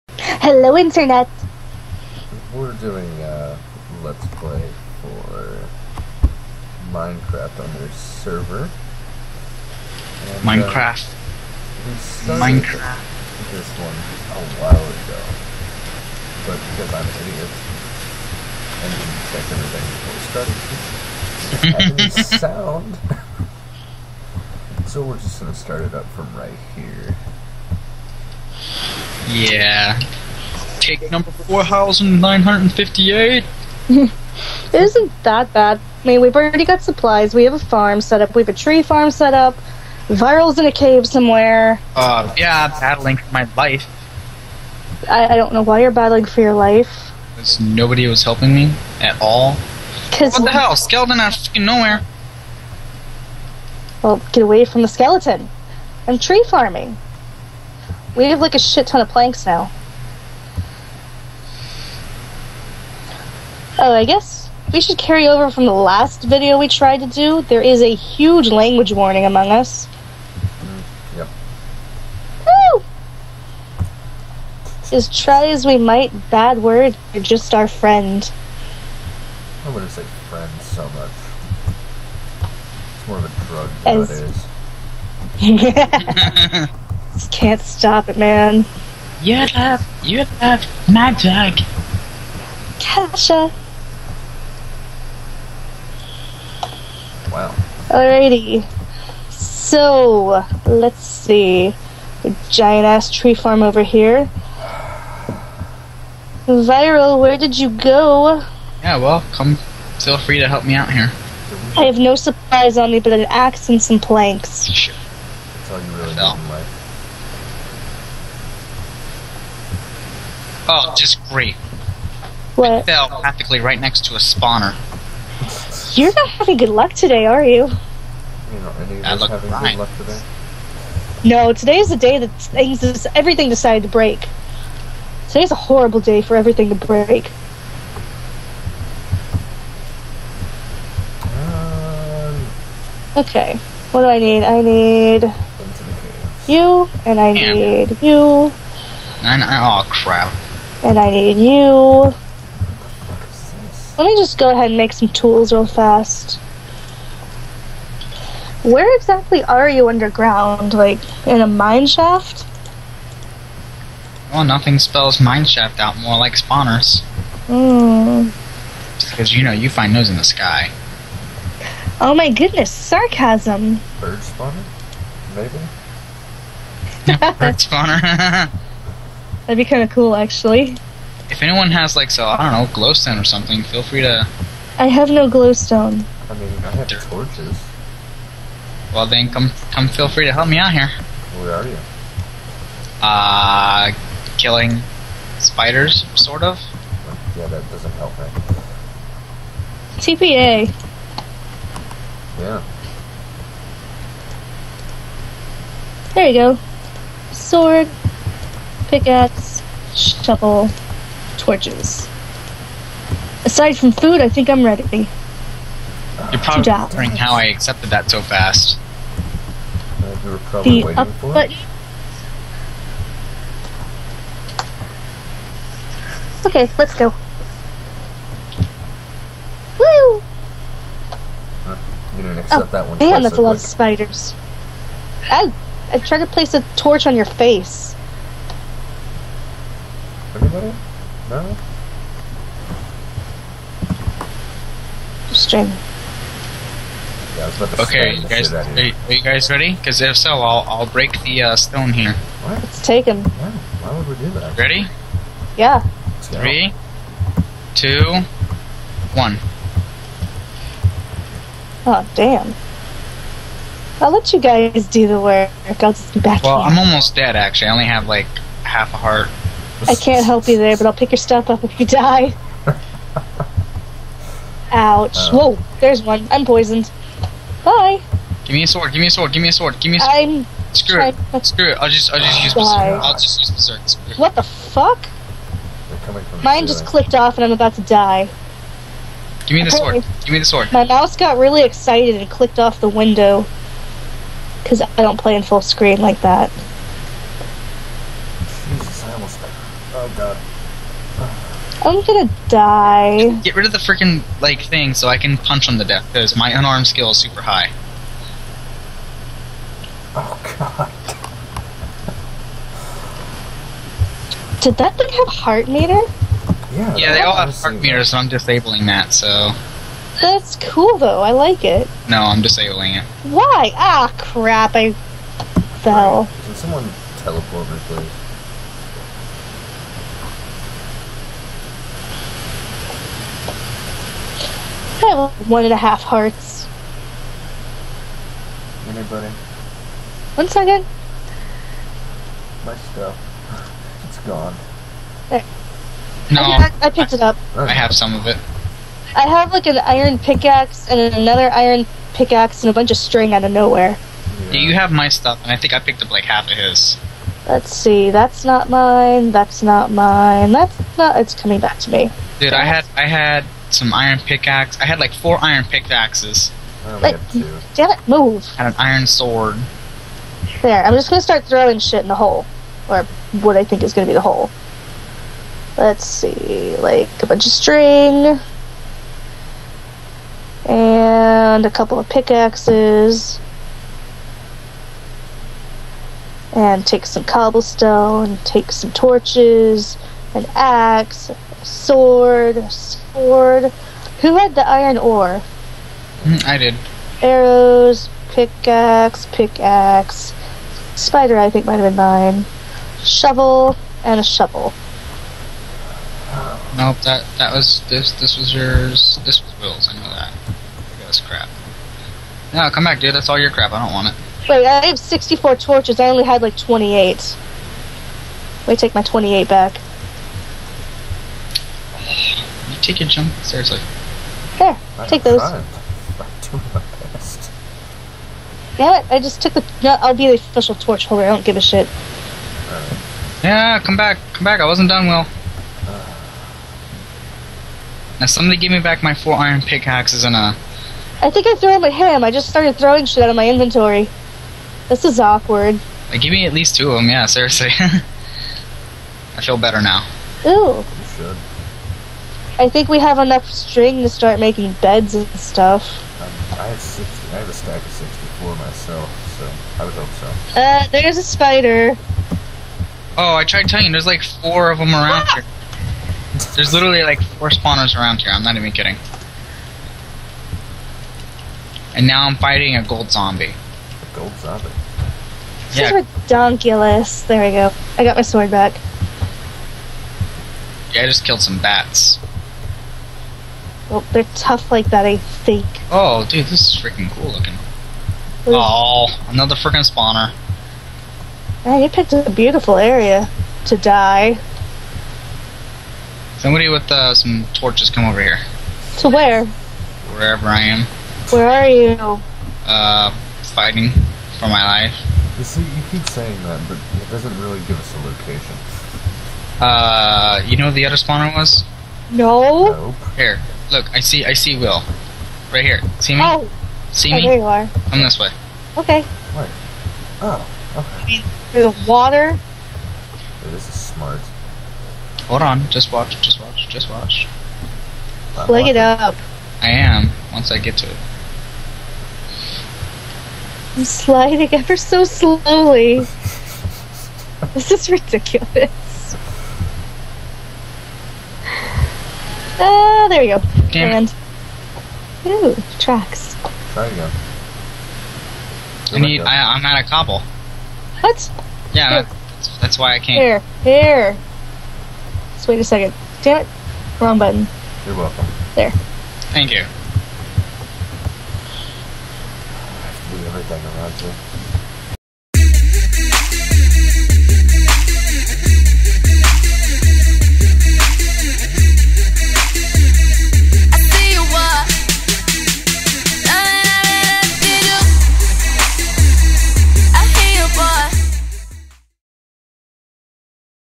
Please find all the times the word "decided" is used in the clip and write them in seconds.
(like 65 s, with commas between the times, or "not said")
133 s.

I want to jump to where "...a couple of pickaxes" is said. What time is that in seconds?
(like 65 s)
381 s.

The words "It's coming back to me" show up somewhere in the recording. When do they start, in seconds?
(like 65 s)
361 s.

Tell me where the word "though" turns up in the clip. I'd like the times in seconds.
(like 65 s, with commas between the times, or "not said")
320 s.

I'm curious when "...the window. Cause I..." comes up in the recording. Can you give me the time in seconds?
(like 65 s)
292 s.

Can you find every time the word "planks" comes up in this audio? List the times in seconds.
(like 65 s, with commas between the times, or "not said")
59 s, 113 s.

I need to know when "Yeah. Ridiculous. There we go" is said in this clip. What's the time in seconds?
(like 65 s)
475 s.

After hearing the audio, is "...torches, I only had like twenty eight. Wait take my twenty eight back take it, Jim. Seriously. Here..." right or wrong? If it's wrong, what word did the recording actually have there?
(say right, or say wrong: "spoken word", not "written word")
right.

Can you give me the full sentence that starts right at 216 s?
You're probably wondering how I accepted that so fast.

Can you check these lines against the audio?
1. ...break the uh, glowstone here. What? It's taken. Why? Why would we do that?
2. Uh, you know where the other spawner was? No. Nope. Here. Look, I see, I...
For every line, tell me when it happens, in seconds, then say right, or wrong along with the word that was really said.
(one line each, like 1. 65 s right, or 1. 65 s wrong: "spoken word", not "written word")
1. 250 s wrong: "stone", not "glowstone"
2. 509 s right.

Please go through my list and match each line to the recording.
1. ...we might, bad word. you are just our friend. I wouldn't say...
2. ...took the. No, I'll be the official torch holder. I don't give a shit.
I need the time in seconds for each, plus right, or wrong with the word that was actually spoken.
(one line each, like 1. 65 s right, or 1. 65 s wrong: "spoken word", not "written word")
1. 75 s right
2. 429 s right.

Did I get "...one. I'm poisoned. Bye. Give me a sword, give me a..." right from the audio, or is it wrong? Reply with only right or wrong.
right.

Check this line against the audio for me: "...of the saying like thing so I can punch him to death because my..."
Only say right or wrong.
wrong.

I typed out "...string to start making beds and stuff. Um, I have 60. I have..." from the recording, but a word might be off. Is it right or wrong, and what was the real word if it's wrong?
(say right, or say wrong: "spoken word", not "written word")
right.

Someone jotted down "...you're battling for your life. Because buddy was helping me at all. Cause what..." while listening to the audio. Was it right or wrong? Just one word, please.
wrong.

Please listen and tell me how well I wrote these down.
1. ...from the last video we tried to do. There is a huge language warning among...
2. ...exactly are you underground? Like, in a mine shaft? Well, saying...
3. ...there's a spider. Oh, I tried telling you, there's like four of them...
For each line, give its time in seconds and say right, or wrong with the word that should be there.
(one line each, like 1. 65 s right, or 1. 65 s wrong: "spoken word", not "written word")
1. 65 s right
2. 158 s wrong: "nothing", not "saying"
3. 460 s right.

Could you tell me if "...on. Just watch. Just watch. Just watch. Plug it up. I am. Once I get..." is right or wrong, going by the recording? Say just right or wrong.
right.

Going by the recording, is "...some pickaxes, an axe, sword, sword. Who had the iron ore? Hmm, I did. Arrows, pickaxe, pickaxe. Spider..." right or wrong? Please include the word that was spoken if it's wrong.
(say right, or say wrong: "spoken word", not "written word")
wrong: "torches", not "pickaxes".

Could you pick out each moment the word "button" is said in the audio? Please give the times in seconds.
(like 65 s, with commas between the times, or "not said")
221 s, 557 s.